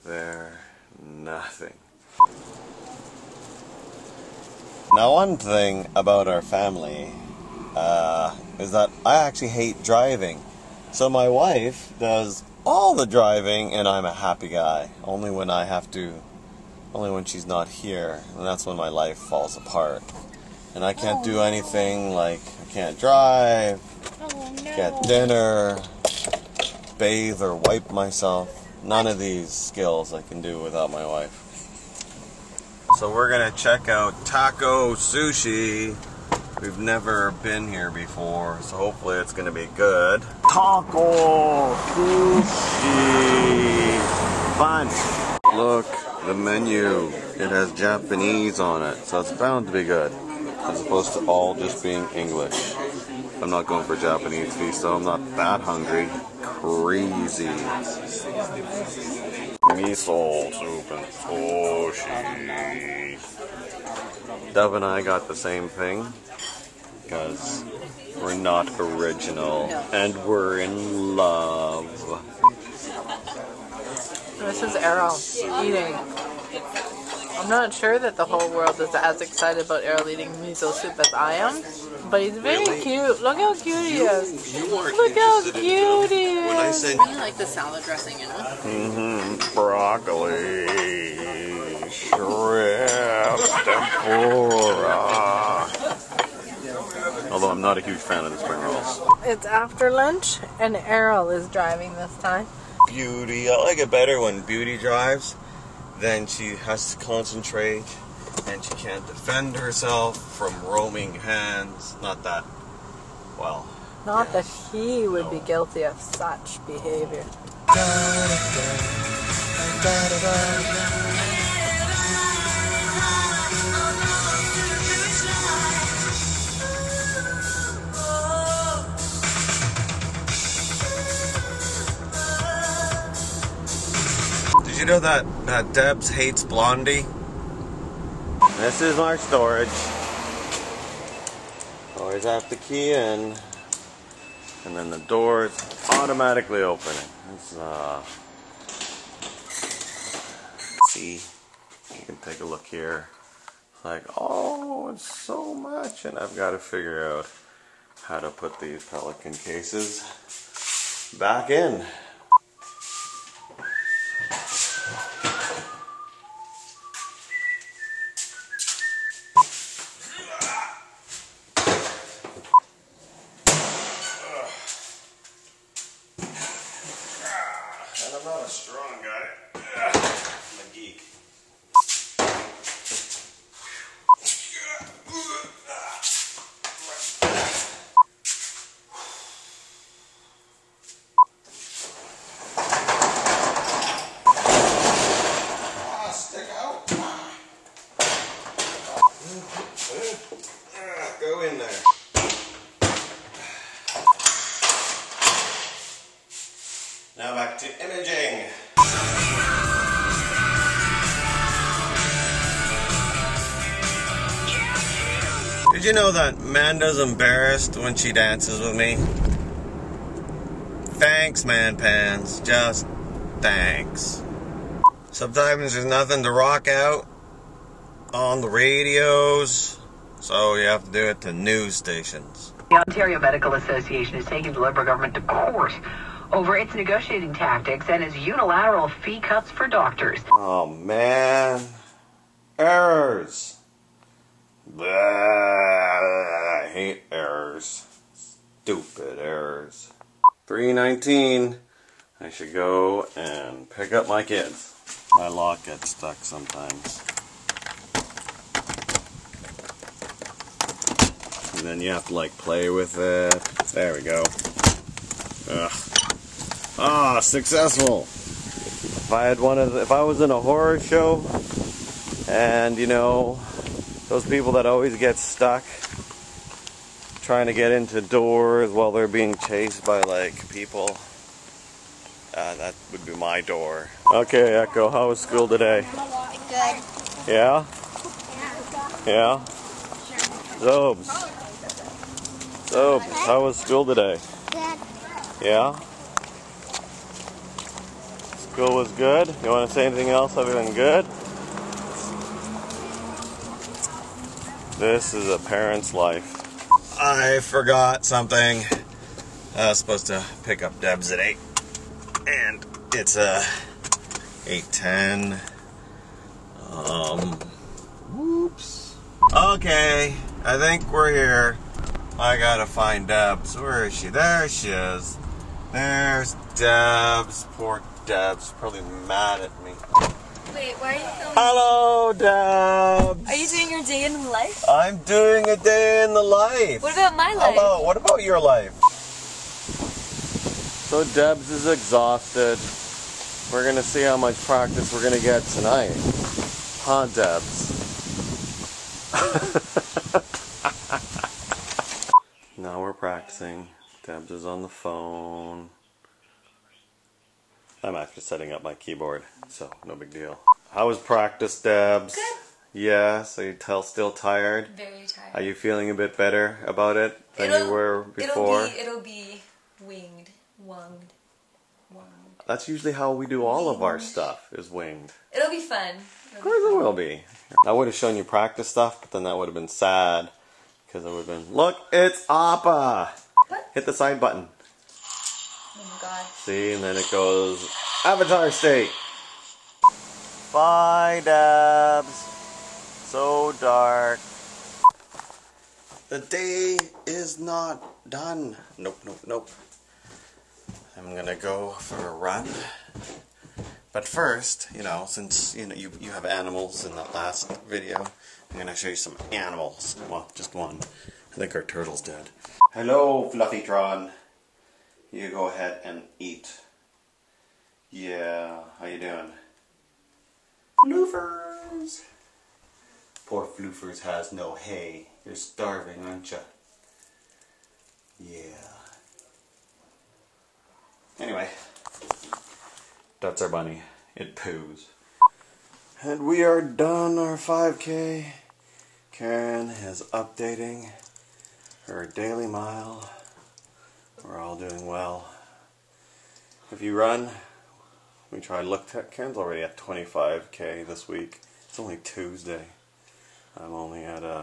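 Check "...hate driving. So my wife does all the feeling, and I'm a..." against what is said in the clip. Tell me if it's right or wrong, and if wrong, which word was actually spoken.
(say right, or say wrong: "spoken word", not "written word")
wrong: "driving", not "feeling".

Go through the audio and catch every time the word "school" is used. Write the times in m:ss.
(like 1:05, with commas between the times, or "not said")
4:45, 4:53, 4:58.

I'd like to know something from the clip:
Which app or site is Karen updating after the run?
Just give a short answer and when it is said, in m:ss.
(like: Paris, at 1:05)
Dailymile, at 7:22.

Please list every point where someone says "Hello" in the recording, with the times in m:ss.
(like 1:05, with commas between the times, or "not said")
5:31, 5:37, 6:52.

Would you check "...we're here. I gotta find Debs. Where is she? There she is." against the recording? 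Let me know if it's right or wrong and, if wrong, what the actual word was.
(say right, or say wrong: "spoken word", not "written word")
right.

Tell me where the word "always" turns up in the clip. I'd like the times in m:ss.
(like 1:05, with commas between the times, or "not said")
2:21, 4:34.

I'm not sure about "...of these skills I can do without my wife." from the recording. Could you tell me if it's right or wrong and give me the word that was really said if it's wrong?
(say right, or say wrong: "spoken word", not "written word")
right.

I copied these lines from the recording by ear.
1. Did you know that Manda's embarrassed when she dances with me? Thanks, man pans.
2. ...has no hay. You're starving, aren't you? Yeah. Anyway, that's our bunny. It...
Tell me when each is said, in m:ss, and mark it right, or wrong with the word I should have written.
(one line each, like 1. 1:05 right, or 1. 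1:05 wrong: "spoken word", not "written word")
1. 3:35 right
2. 7:04 right.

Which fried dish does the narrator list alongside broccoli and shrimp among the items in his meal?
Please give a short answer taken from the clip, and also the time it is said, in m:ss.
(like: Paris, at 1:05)
tempura, at 1:33.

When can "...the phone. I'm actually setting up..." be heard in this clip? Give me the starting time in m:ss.
5:54.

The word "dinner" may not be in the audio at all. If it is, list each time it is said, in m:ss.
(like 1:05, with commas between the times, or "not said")
0:25.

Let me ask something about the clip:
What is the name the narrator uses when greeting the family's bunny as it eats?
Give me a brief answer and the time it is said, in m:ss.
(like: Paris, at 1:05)
Fluffytron, at 6:53.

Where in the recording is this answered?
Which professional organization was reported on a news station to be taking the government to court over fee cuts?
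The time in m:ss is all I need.
3:52.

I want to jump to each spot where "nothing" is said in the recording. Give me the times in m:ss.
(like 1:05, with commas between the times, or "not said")
0:01, 3:45.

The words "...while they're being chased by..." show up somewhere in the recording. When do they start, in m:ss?
4:38.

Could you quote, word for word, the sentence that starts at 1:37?
Although I'm not a huge fan of the spring rolls.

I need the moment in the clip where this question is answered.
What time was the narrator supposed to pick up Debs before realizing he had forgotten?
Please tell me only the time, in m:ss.
5:11.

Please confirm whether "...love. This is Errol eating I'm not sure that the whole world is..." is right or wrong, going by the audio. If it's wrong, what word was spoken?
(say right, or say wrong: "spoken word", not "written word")
right.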